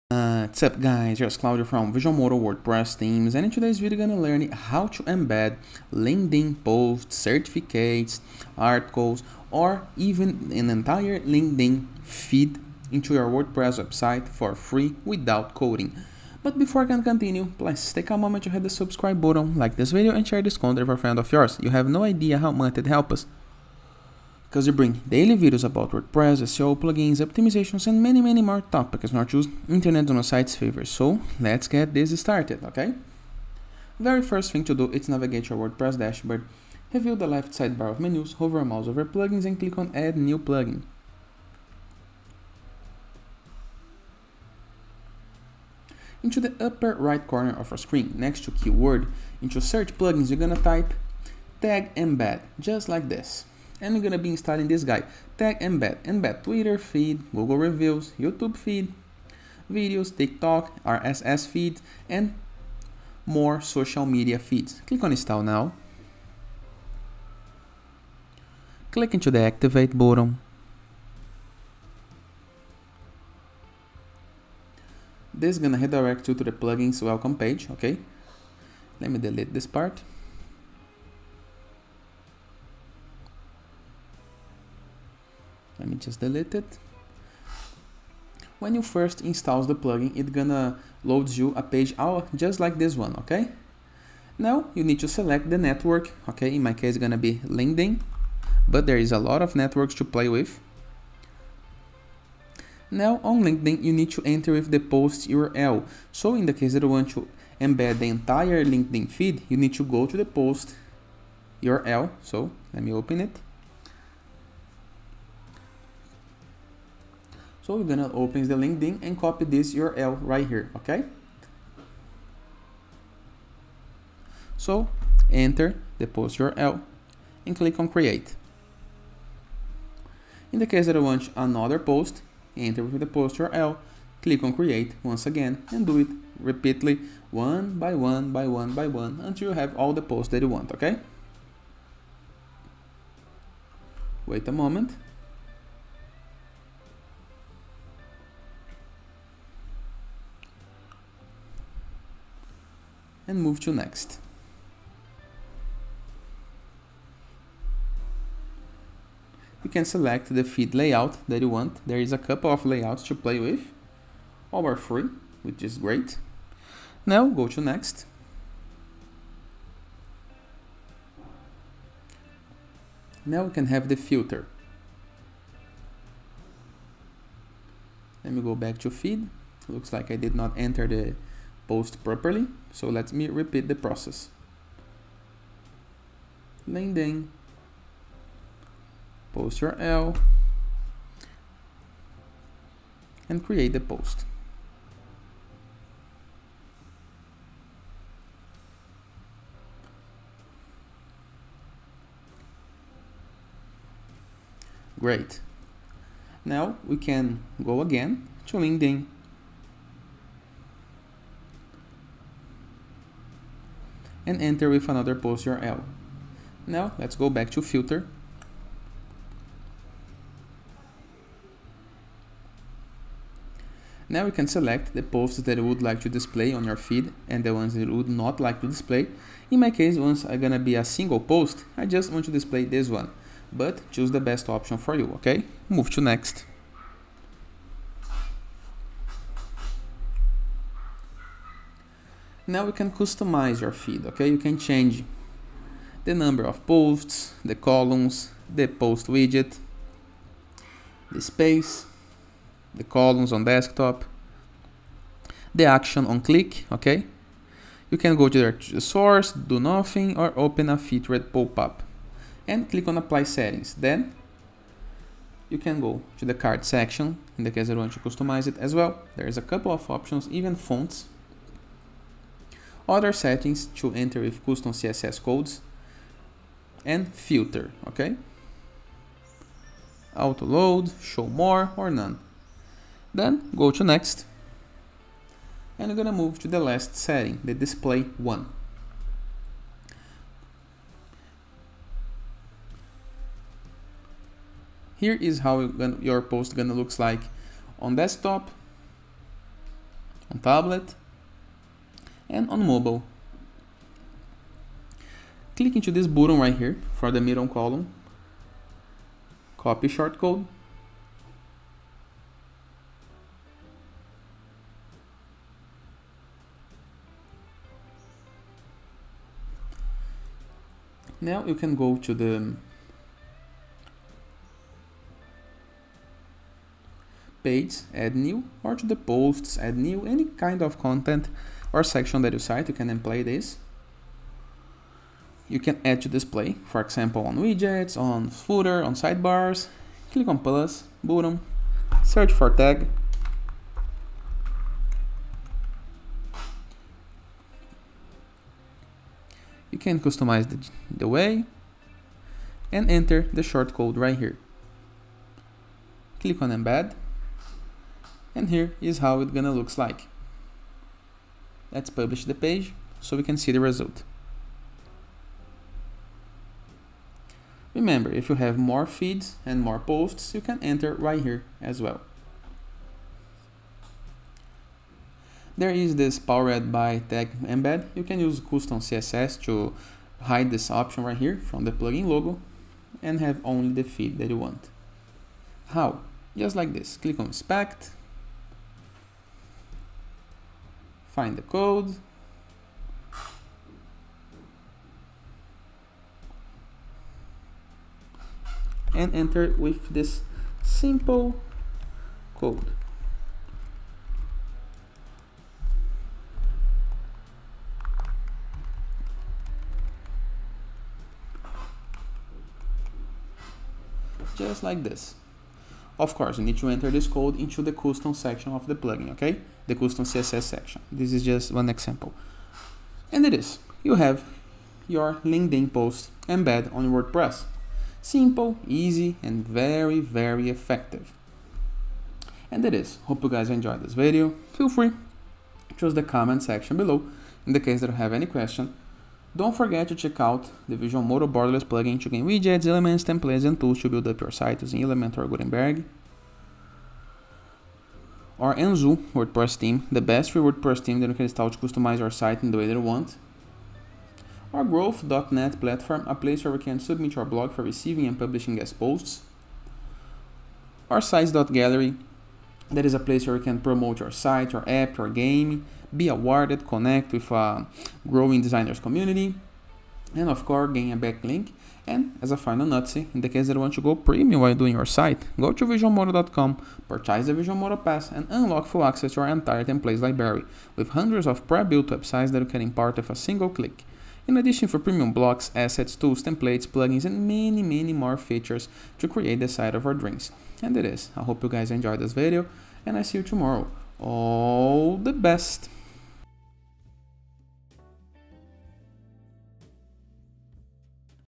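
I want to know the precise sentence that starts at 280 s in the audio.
Auto load, show more or none.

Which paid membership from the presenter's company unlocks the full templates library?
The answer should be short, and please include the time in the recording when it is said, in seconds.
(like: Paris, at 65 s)
Visual Modo Pass, at 477 s.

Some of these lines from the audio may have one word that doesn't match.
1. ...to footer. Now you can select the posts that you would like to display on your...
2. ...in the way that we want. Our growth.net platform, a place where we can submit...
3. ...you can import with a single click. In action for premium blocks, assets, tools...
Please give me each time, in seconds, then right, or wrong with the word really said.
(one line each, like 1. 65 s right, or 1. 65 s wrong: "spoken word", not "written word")
1. 217 s wrong: "filter", not "footer"
2. 452 s right
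3. 482 s wrong: "addition", not "action".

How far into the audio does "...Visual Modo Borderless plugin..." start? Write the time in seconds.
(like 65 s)
440 s.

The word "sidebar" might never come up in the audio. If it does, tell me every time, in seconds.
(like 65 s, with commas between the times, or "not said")
37 s, 338 s.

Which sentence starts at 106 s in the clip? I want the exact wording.
So in the case that you want to embed the entire LinkedIn feed, you need to go to the post URL.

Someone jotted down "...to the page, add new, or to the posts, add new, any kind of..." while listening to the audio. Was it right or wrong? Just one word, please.
right.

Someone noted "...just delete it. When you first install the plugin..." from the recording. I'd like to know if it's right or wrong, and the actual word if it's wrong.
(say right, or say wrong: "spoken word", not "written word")
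right.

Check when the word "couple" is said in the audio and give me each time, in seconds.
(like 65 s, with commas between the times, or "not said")
162 s, 269 s.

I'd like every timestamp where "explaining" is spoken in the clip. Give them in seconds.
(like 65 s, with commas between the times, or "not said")
not said.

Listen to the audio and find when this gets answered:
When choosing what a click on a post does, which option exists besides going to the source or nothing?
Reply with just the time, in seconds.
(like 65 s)
260 s.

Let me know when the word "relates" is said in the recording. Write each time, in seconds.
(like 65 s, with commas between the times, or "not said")
not said.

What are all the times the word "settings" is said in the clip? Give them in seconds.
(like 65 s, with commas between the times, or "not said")
263 s, 273 s, 286 s.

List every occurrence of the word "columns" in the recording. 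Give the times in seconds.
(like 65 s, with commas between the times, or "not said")
247 s, 252 s, 307 s.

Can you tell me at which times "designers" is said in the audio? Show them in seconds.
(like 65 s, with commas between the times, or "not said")
468 s.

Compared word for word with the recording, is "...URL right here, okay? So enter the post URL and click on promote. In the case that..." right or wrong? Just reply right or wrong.
wrong.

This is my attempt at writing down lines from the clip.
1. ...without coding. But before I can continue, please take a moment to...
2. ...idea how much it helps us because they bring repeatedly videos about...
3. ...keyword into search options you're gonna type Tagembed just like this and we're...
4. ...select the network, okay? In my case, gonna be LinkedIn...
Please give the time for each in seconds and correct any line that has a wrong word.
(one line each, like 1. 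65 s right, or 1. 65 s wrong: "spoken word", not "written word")
1. 15 s right
2. 22 s wrong: "daily", not "repeatedly"
3. 48 s wrong: "plugins", not "options"
4. 95 s right.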